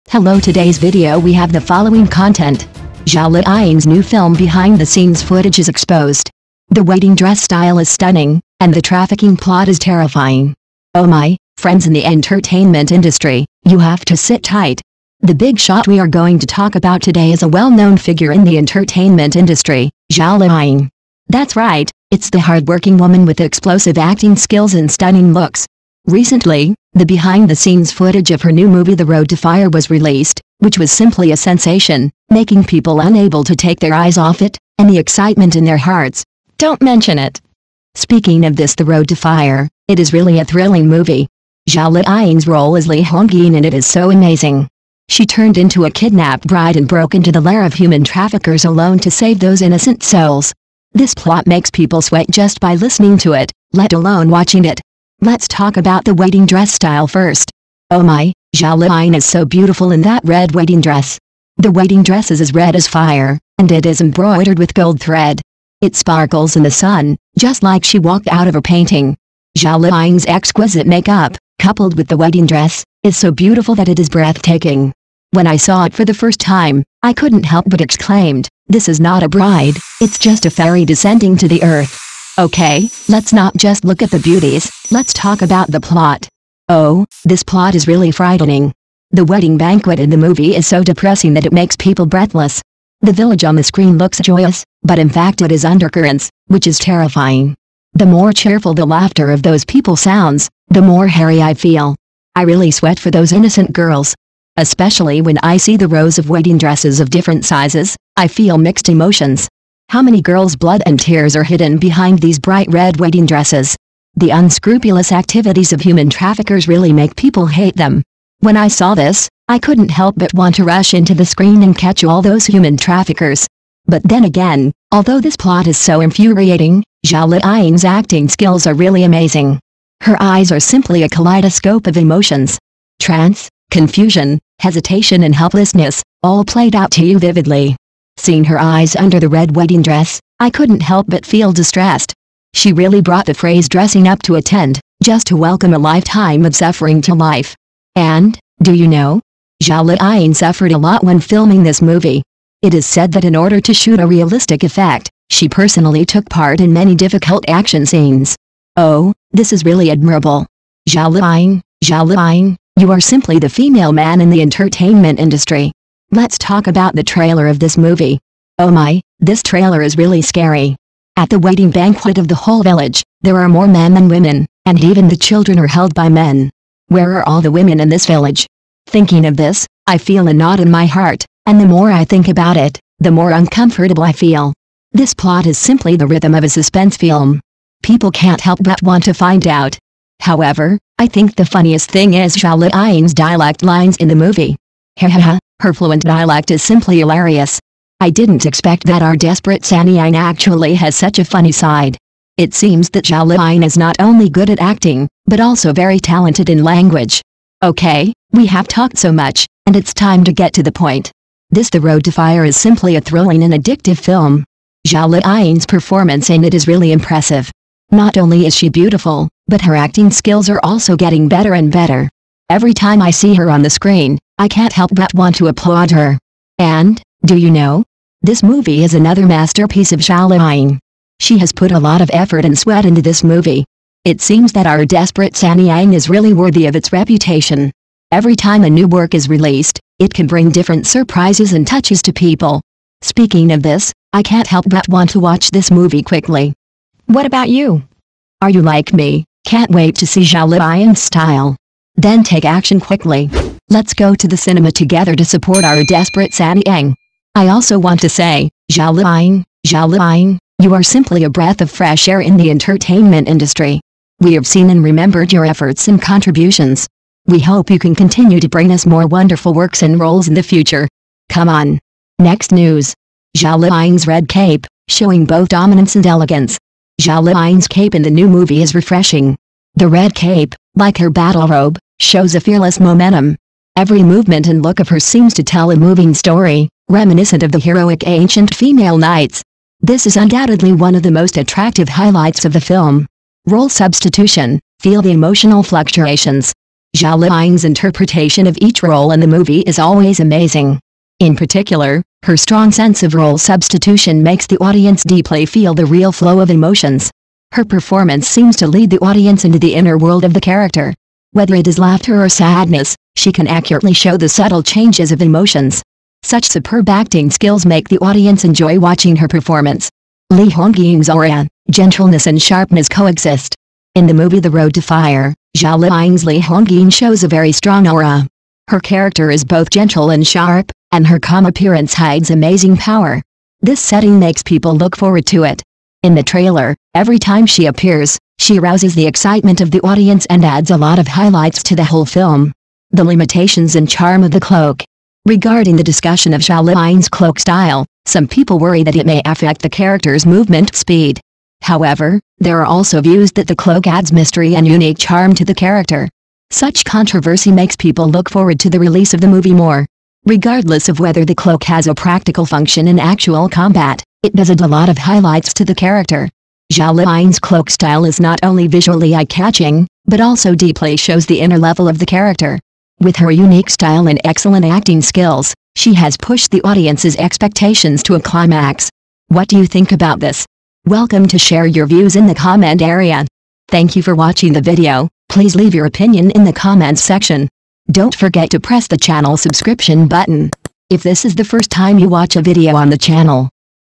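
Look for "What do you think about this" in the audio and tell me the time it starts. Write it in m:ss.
6:19.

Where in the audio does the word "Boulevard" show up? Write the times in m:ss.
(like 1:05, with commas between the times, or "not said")
not said.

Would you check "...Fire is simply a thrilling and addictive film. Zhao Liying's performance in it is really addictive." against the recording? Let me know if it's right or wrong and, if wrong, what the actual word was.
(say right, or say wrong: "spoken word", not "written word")
wrong: "impressive", not "addictive".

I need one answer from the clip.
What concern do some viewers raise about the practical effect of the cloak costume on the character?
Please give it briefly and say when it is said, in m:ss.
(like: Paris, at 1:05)
movement speed, at 5:50.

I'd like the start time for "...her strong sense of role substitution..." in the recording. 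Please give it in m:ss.
5:02.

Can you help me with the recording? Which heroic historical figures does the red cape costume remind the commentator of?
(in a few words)
ancient female knights.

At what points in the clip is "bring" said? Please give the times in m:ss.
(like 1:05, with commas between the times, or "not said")
4:00, 4:28.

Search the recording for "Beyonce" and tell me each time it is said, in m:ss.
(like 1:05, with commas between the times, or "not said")
not said.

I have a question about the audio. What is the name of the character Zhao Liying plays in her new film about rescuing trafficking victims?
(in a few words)
Li Hongyin.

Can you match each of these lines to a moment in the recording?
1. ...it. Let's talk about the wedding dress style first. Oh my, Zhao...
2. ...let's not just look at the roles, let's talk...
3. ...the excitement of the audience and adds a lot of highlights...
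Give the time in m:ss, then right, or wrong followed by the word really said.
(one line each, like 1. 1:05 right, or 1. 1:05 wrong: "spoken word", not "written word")
1. 0:54 right
2. 1:23 wrong: "beauties", not "roles"
3. 5:38 right.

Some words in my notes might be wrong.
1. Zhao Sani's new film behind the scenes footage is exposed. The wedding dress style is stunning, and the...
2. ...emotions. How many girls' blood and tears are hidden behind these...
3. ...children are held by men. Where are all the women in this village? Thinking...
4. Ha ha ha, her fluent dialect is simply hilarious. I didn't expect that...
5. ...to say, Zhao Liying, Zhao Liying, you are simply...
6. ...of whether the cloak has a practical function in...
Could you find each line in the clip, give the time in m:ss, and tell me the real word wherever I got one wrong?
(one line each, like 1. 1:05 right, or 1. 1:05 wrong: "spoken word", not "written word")
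1. 0:03 wrong: "Liying", not "Sani"
2. 1:48 right
3. 2:55 right
4. 3:14 right
5. 4:18 right
6. 6:00 right.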